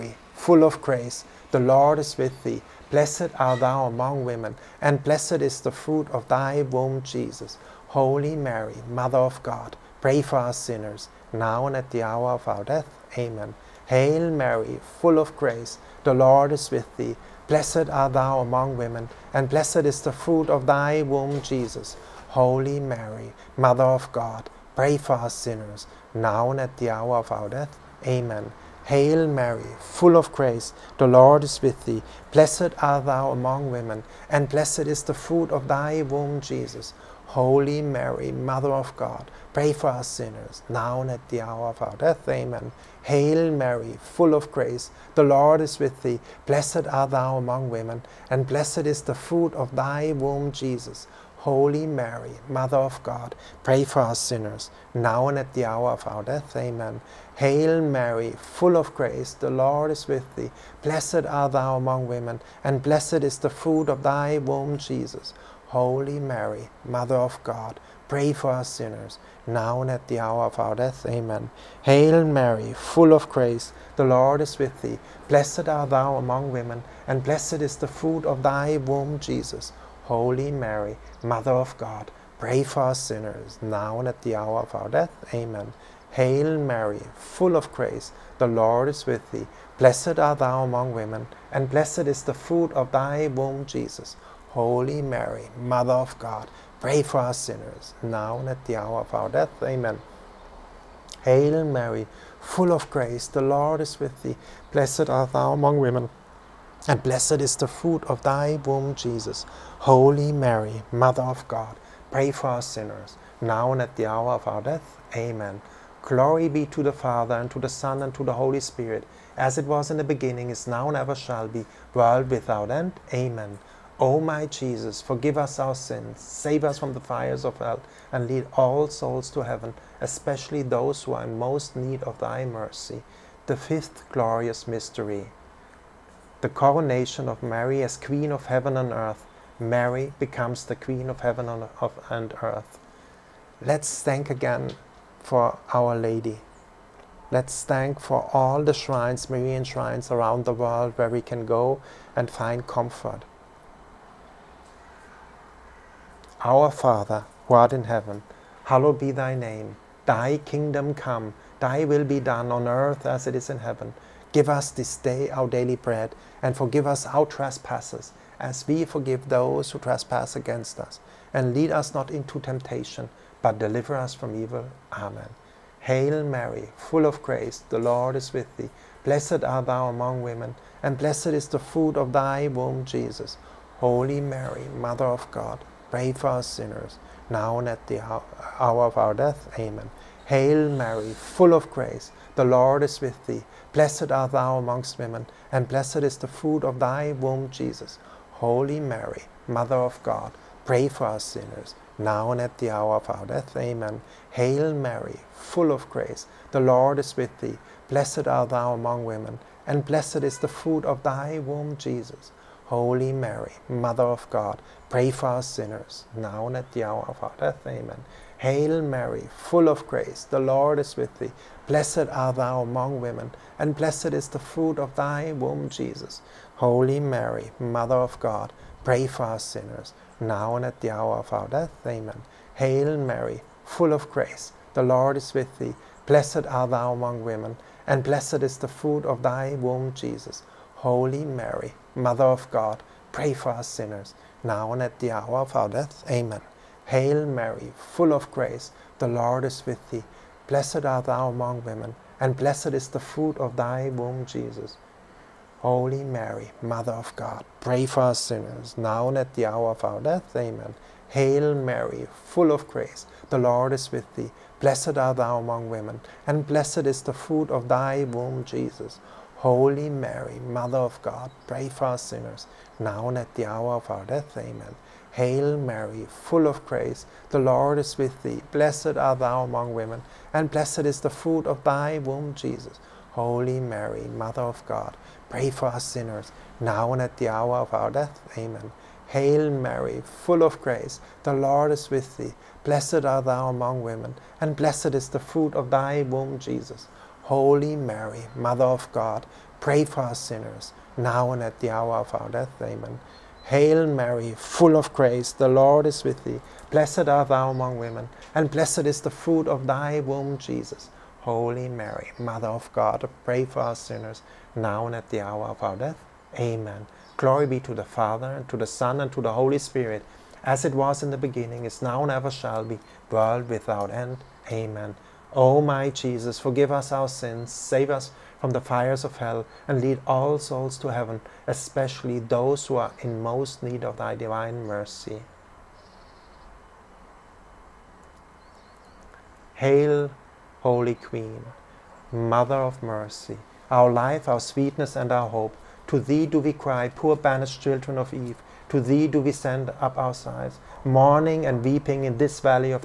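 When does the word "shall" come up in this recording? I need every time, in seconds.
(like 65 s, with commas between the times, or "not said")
121 s, 322 s.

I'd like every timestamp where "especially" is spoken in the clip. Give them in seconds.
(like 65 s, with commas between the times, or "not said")
130 s, 331 s.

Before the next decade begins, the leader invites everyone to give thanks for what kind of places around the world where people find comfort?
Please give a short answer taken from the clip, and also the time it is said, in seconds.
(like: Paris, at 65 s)
Marian shrines, at 149 s.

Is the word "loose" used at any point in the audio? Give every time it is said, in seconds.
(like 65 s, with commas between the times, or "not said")
not said.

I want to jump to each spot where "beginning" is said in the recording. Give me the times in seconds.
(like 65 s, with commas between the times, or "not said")
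120 s, 321 s.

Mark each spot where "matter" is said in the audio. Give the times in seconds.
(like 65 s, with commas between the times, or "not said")
not said.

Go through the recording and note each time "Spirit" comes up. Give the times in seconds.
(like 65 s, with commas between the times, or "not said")
118 s, 319 s.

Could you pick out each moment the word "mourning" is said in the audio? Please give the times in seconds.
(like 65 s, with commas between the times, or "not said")
350 s.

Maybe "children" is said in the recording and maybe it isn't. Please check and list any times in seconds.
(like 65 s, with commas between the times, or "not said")
347 s.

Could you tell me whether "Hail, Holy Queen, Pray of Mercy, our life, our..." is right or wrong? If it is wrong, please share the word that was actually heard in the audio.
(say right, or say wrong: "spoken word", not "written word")
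wrong: "Mother", not "Pray".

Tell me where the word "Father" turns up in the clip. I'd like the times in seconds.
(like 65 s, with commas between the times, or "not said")
116 s, 156 s, 317 s.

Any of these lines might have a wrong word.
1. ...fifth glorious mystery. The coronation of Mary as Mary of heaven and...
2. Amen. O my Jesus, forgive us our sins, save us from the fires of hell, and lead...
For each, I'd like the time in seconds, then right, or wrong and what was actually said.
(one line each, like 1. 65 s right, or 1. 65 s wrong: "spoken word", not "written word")
1. 133 s wrong: "Queen", not "Mary"
2. 324 s right.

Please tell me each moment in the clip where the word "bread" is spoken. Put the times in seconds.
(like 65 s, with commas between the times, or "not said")
165 s.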